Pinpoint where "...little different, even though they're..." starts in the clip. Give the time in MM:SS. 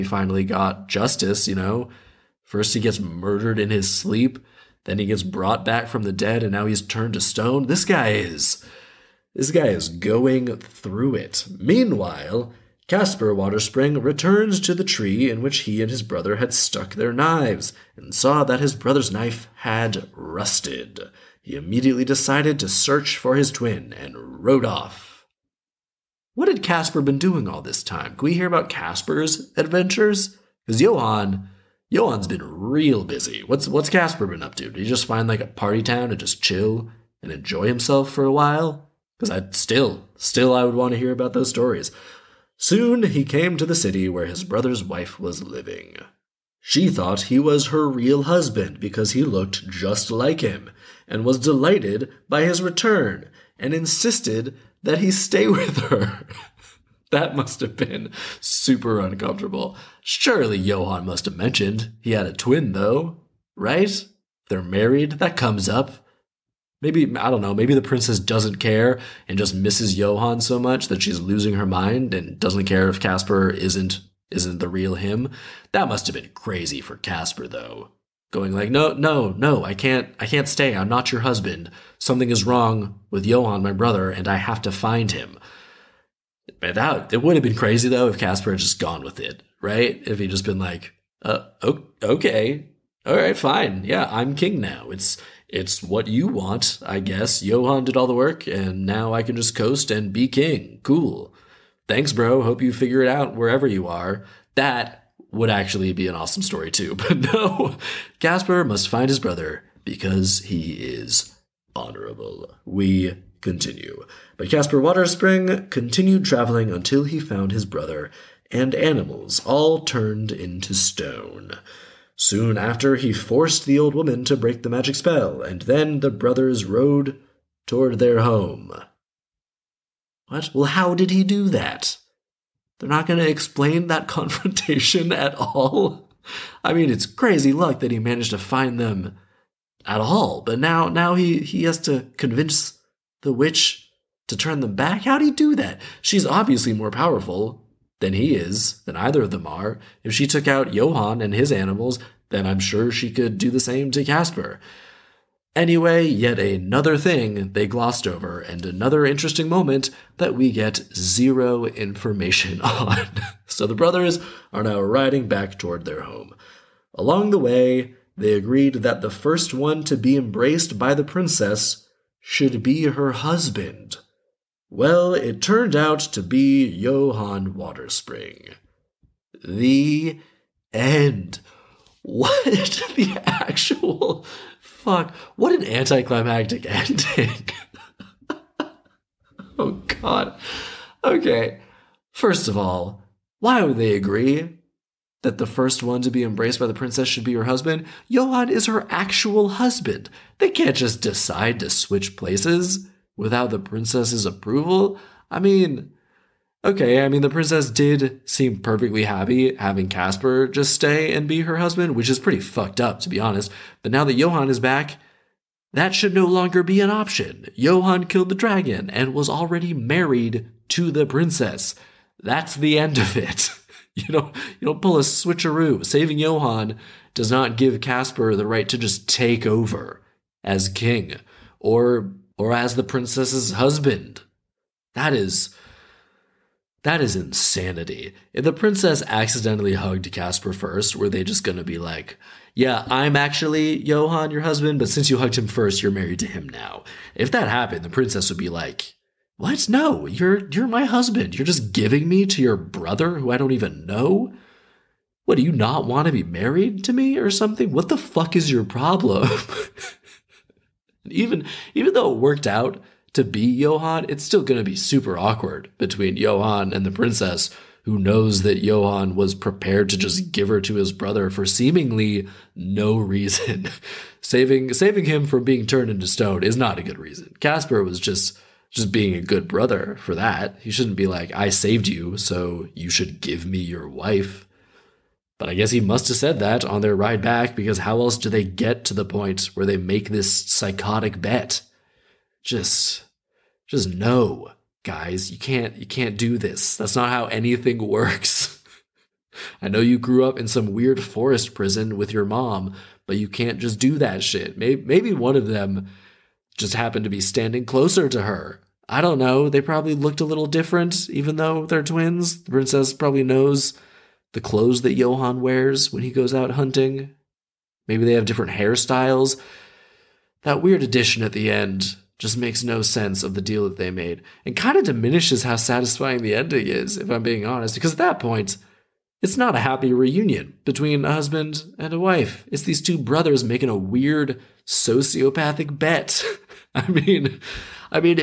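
05:10.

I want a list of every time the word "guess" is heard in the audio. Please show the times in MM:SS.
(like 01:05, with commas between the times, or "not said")
01:36, 04:45.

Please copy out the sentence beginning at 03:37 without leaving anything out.
Johan killed the dragon and was already married to the princess.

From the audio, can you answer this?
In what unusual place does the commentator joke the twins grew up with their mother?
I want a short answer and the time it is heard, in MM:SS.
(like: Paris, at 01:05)
forest prison, at 05:01.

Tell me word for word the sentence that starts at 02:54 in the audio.
Well, it turned out to be Johann Waterspring.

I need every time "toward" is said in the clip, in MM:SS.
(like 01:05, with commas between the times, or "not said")
02:07, 02:45.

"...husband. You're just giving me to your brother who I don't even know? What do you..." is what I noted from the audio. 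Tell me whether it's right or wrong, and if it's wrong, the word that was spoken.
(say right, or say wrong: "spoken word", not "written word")
right.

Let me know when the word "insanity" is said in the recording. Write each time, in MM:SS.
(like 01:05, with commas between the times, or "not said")
03:57.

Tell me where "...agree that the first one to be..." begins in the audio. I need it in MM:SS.
03:13.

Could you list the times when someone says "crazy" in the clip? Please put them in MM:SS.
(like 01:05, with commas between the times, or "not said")
01:16, 01:27, 02:17.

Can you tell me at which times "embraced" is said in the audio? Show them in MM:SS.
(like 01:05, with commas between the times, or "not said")
02:50, 03:16.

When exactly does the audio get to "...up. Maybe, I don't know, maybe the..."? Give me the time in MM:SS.
01:05.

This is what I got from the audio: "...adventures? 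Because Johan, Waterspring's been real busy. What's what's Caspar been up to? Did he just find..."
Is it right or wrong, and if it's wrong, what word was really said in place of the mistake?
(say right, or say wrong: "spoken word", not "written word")
wrong: "Johan", not "Waterspring".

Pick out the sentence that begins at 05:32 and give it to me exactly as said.
It's these two brothers making a weird sociopathic bet.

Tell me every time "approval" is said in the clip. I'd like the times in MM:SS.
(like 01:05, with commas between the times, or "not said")
03:24.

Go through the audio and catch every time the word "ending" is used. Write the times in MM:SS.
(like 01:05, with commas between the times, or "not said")
03:06, 05:26.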